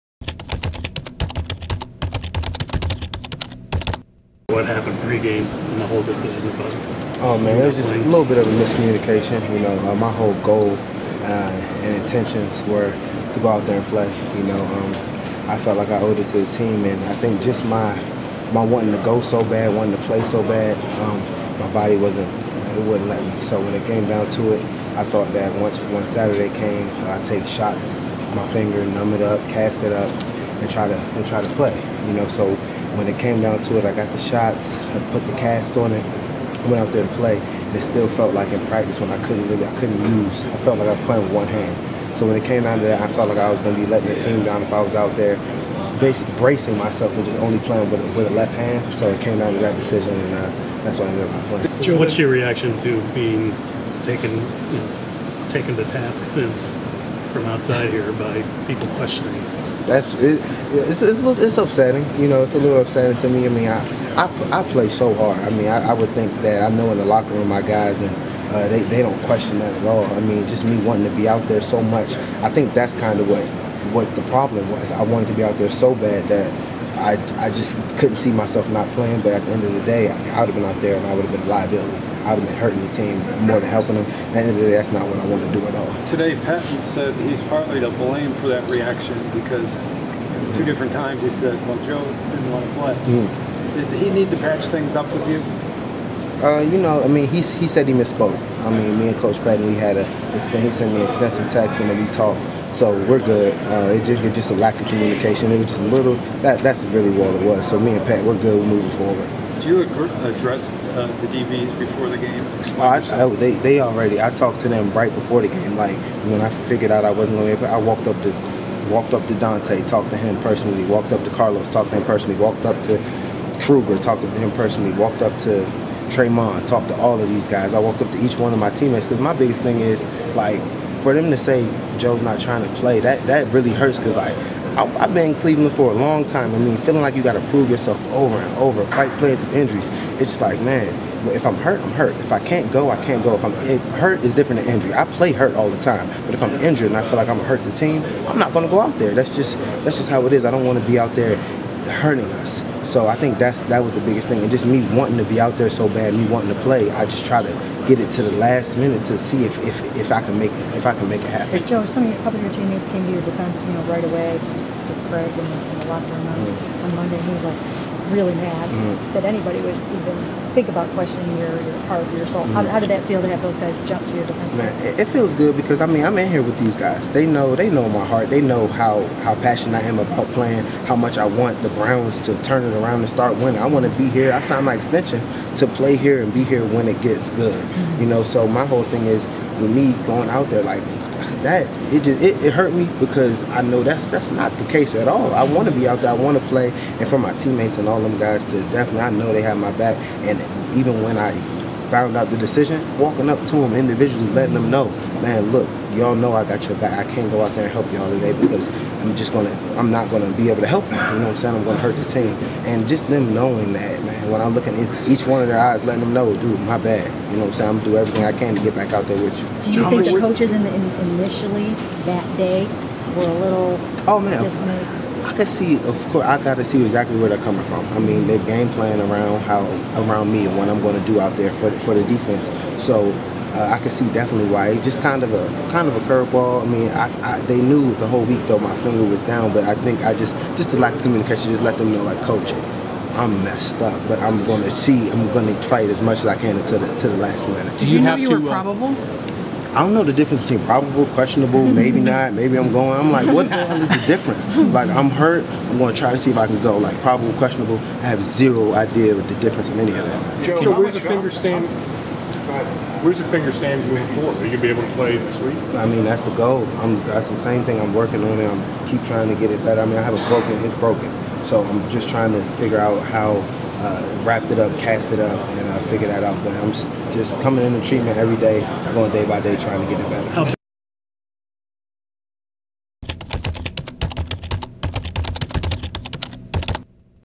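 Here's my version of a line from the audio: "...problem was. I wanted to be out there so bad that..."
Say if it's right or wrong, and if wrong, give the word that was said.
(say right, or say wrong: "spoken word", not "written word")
right.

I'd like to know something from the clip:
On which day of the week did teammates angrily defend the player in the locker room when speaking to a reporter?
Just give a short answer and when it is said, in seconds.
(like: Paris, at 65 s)
Monday, at 166 s.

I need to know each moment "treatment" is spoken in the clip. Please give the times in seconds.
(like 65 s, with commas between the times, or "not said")
277 s.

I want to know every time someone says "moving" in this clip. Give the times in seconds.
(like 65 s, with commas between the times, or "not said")
108 s, 263 s.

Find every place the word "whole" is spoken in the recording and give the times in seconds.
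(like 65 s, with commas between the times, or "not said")
5 s, 10 s, 188 s, 238 s.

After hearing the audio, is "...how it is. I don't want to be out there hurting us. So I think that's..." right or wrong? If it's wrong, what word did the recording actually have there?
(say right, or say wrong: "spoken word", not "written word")
right.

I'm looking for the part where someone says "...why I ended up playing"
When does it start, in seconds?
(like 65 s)
50 s.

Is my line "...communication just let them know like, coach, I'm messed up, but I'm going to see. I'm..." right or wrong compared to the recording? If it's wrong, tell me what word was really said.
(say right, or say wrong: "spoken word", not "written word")
right.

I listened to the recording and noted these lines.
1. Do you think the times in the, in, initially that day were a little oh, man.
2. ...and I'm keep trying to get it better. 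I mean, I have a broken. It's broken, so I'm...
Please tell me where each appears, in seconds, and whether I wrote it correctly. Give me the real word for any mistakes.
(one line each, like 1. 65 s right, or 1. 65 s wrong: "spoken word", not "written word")
1. 219 s wrong: "coaches", not "times"
2. 268 s right.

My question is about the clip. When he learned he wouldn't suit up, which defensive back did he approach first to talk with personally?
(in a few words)
Dante.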